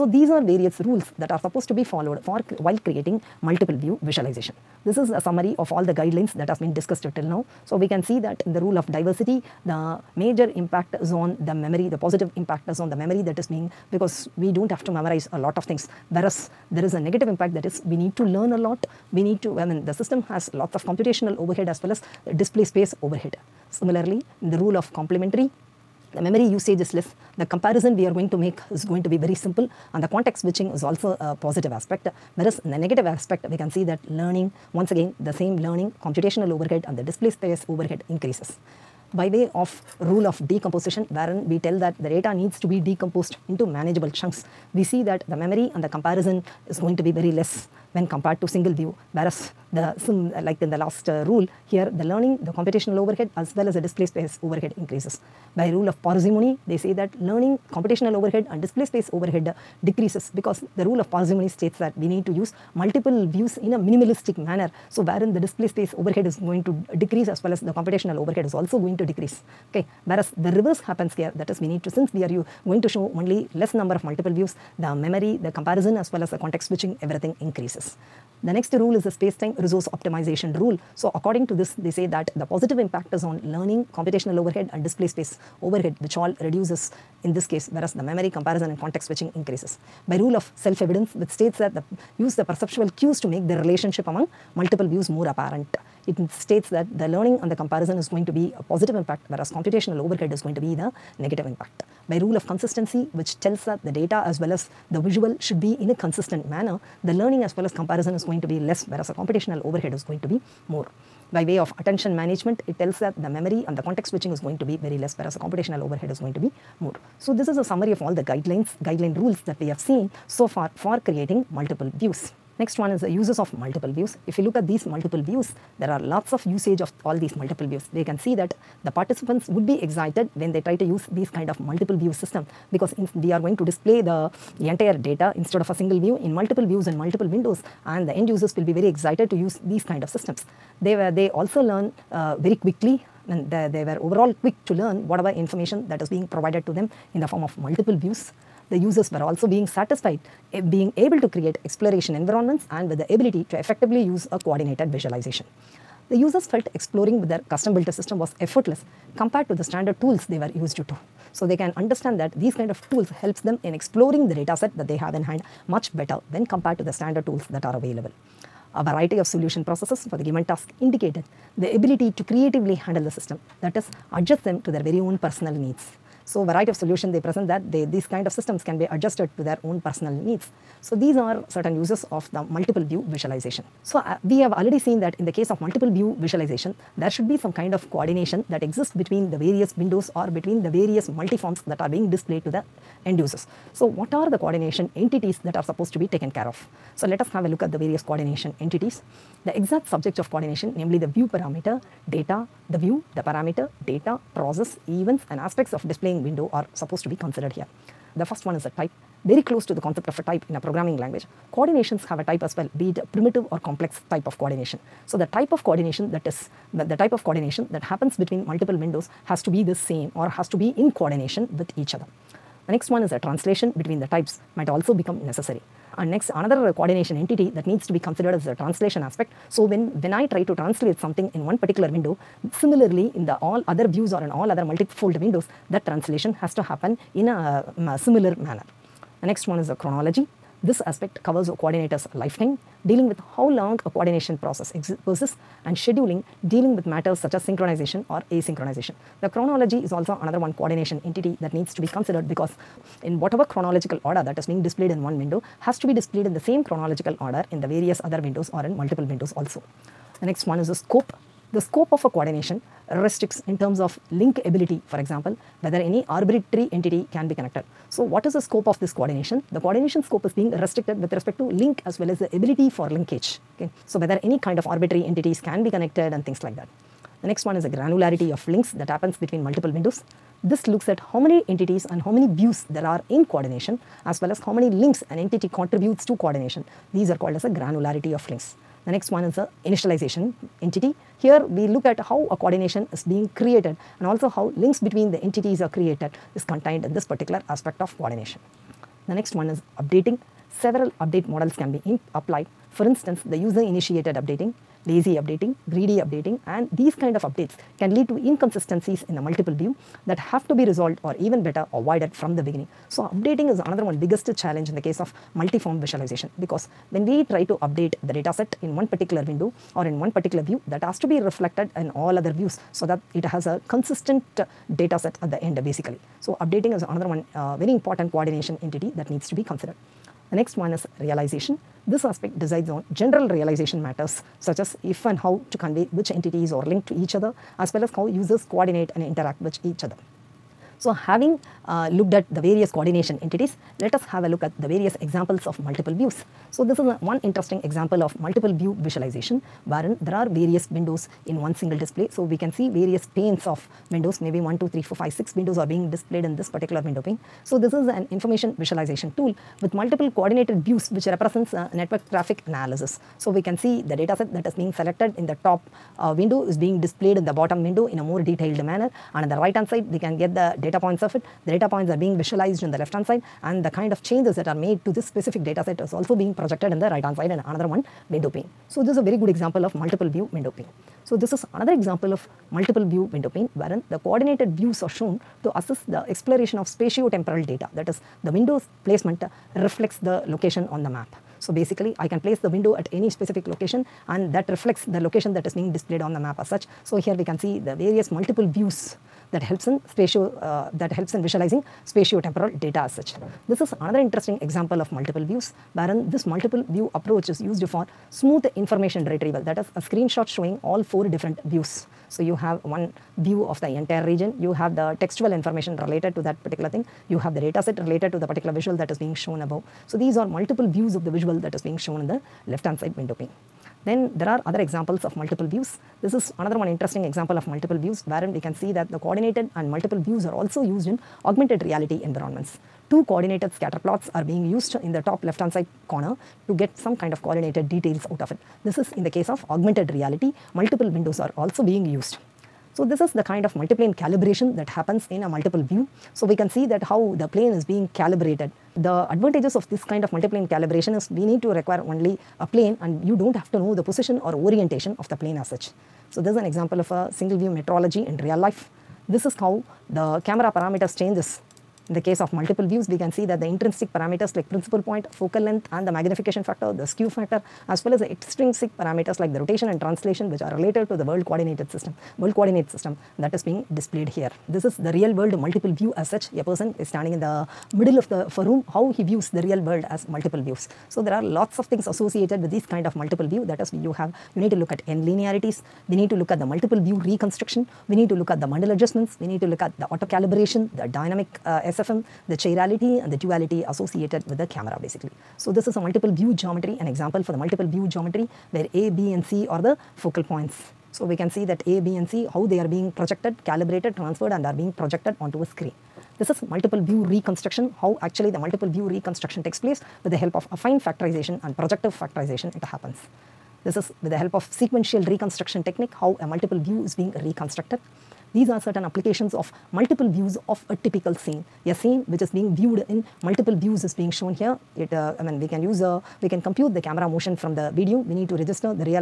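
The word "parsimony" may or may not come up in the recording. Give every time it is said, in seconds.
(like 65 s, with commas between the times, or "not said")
56 s, 61 s.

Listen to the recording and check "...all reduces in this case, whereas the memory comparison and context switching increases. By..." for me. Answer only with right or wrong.
right.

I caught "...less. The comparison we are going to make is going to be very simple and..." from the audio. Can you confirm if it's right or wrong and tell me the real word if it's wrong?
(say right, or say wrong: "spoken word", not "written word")
right.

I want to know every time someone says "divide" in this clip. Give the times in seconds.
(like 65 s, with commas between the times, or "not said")
not said.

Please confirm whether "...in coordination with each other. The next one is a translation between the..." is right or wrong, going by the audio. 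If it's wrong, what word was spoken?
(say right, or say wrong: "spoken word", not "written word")
right.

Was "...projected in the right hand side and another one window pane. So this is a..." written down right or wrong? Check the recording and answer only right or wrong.
right.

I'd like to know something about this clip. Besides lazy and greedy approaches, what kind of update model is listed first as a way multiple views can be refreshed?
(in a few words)
User-initiated updating.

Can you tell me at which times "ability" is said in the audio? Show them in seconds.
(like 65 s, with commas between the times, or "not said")
153 s, 171 s, 264 s, 272 s.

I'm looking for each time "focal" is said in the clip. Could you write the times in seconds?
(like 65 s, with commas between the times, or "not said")
465 s, 499 s.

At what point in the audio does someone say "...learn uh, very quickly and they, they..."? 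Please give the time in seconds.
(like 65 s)
141 s.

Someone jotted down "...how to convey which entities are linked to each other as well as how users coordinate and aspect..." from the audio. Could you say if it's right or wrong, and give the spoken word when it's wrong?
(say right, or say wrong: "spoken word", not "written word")
wrong: "interact", not "aspect".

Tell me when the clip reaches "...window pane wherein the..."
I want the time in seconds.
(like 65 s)
383 s.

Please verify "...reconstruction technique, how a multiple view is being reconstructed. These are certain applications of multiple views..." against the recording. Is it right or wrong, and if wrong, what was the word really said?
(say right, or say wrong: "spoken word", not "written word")
right.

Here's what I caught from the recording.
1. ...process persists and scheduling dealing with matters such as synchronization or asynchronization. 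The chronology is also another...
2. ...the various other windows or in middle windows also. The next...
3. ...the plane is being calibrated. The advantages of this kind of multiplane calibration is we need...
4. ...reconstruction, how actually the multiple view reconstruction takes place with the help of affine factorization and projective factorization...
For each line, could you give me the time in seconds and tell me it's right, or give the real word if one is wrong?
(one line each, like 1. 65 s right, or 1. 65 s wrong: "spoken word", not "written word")
1. 244 s right
2. 257 s wrong: "multiple", not "middle"
3. 447 s right
4. 507 s right.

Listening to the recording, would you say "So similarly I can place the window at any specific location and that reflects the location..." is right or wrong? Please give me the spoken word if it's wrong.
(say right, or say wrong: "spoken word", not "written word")
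wrong: "basically", not "similarly".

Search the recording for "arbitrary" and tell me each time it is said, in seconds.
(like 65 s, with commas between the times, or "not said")
266 s, 274 s.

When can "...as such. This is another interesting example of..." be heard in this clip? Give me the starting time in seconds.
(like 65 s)
402 s.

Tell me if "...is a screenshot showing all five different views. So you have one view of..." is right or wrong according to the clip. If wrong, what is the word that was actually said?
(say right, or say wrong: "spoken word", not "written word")
wrong: "four", not "five".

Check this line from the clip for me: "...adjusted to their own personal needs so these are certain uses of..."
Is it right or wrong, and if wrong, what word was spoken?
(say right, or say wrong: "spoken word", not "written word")
right.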